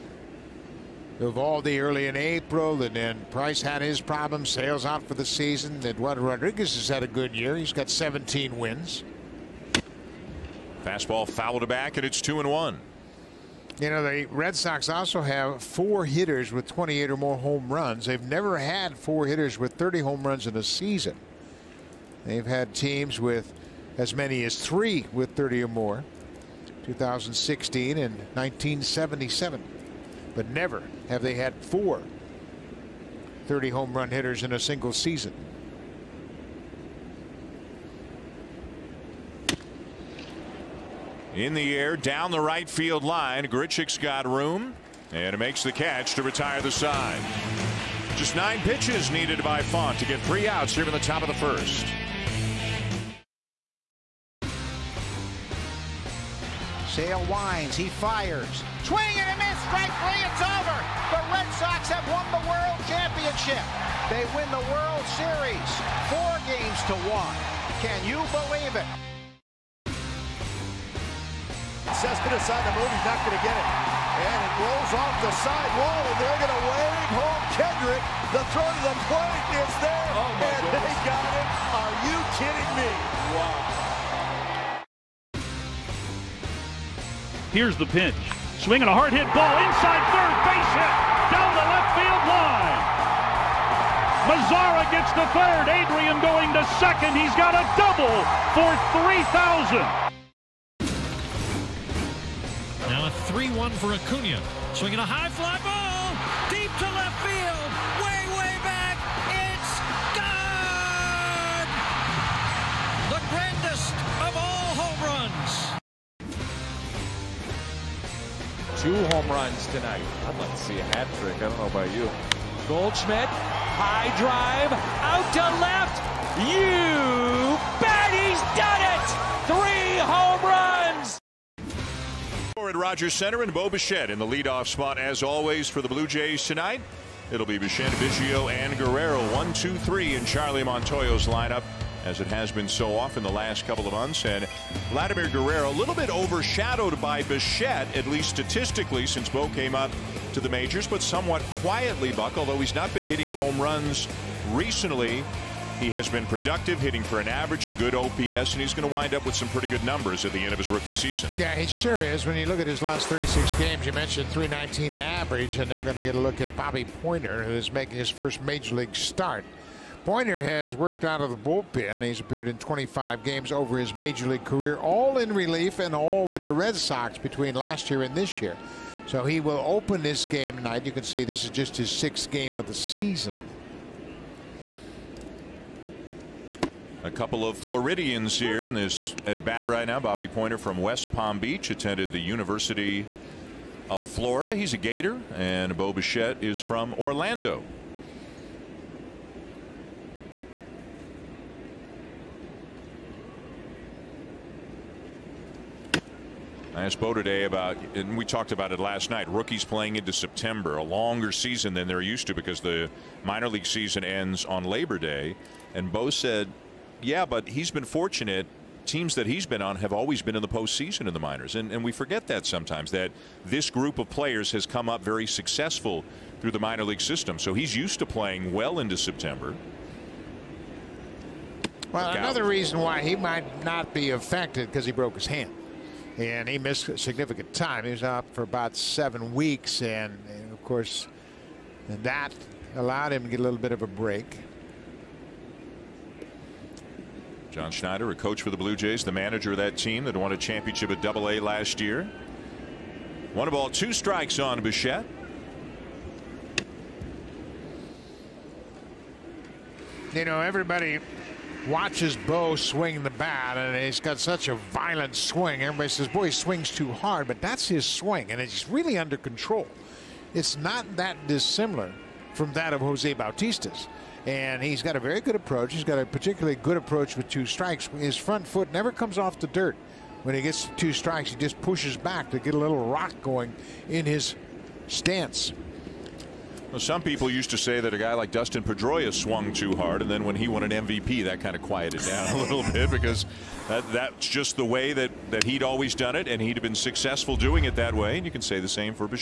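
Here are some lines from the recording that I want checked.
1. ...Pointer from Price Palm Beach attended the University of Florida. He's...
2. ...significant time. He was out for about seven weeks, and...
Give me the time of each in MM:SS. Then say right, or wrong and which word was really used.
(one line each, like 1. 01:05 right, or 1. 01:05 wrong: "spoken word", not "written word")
1. 03:10 wrong: "West", not "Price"
2. 03:56 right.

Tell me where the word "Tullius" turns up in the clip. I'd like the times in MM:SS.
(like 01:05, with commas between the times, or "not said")
not said.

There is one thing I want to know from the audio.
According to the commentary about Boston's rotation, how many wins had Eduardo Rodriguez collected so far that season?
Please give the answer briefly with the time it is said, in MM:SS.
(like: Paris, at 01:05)
17, at 00:07.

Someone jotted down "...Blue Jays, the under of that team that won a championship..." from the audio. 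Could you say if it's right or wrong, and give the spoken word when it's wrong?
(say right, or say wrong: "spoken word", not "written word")
wrong: "manager", not "under".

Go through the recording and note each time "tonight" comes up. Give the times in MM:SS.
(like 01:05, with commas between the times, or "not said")
01:59, 02:16, 03:00.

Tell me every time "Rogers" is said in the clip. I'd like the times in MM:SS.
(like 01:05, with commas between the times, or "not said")
02:12.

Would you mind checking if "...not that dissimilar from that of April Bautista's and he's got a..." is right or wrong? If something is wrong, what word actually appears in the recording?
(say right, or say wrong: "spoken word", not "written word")
wrong: "Jose", not "April".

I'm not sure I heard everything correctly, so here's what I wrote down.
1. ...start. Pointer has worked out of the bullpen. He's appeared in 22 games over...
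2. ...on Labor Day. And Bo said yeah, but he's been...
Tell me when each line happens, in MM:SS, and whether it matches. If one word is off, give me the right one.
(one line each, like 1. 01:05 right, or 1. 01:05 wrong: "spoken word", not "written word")
1. 02:48 wrong: "25", not "22"
2. 03:34 right.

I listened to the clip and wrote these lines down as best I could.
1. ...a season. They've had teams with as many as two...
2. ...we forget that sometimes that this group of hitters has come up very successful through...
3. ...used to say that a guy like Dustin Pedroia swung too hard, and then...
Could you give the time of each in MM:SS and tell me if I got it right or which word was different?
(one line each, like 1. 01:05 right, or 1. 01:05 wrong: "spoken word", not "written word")
1. 00:20 wrong: "three", not "two"
2. 03:41 wrong: "players", not "hitters"
3. 04:47 right.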